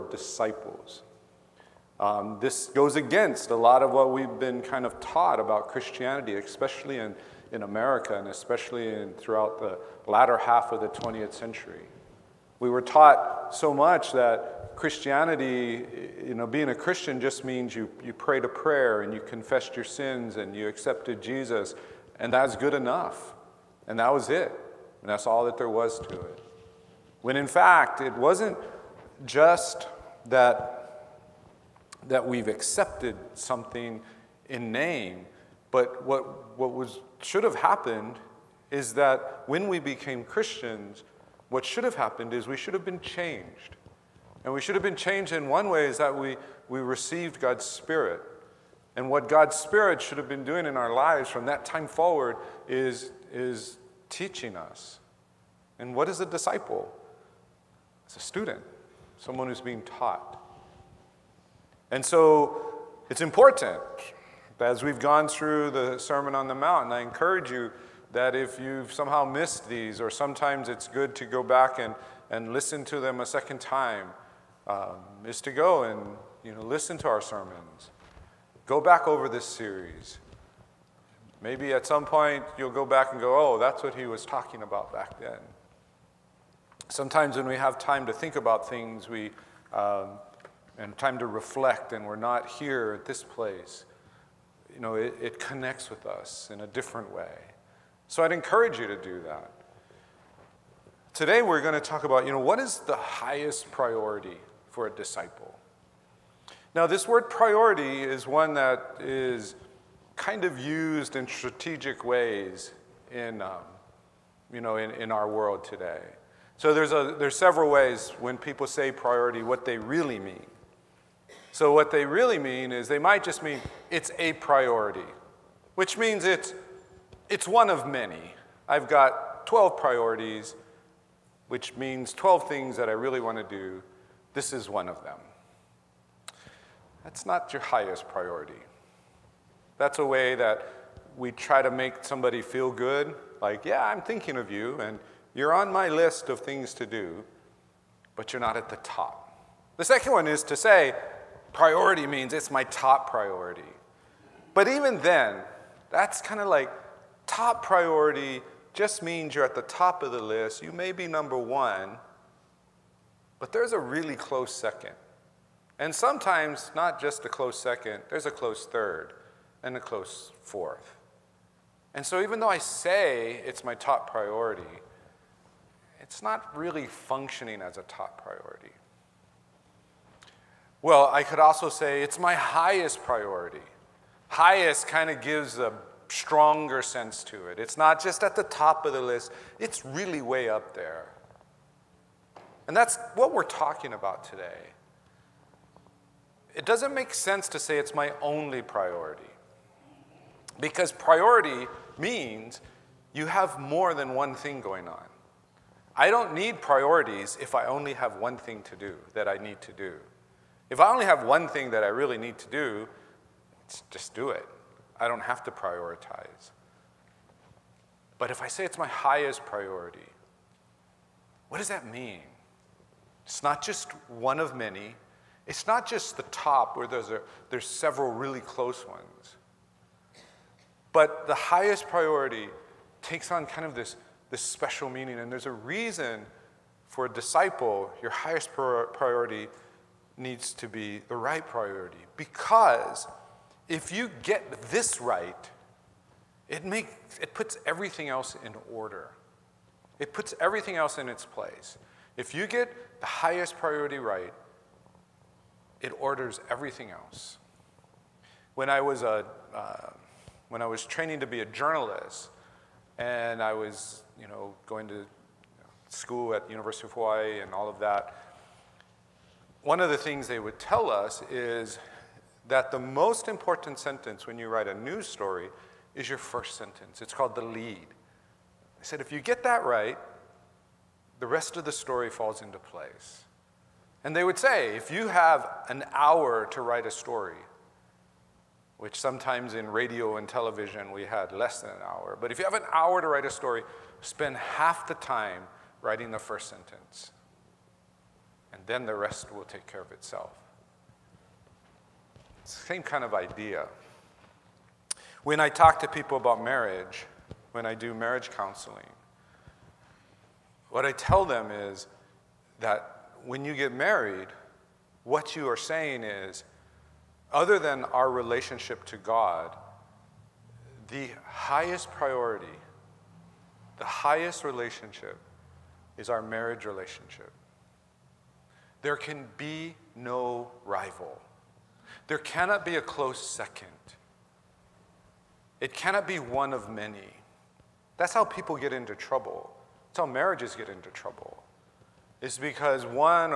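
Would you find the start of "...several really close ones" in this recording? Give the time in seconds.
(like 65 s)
227 s.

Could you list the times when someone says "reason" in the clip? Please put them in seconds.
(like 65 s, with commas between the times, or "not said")
235 s.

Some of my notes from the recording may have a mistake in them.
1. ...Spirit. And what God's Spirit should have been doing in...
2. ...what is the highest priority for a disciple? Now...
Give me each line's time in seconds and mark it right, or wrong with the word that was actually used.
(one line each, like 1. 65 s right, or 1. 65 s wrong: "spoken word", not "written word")
1. 47 s right
2. 102 s right.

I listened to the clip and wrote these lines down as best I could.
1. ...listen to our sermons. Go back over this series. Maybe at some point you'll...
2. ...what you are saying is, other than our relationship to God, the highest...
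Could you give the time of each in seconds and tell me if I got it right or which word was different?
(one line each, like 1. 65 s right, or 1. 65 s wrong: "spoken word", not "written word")
1. 76 s right
2. 315 s right.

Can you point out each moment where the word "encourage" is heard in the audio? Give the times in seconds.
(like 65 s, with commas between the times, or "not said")
67 s, 98 s.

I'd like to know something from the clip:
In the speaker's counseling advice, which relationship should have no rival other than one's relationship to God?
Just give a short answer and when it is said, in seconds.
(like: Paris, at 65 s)
Marriage relationship, at 326 s.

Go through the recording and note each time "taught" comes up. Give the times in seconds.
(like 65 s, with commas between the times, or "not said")
5 s, 12 s, 59 s.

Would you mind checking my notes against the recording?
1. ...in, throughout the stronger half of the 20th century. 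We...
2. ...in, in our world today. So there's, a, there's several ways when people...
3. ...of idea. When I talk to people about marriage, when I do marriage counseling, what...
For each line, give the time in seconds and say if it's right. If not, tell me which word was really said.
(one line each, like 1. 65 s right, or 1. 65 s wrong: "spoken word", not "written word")
1. 8 s wrong: "latter", not "stronger"
2. 114 s right
3. 303 s right.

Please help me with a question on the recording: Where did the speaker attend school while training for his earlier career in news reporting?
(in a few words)
University of Hawaii.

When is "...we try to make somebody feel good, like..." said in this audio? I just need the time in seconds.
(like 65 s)
141 s.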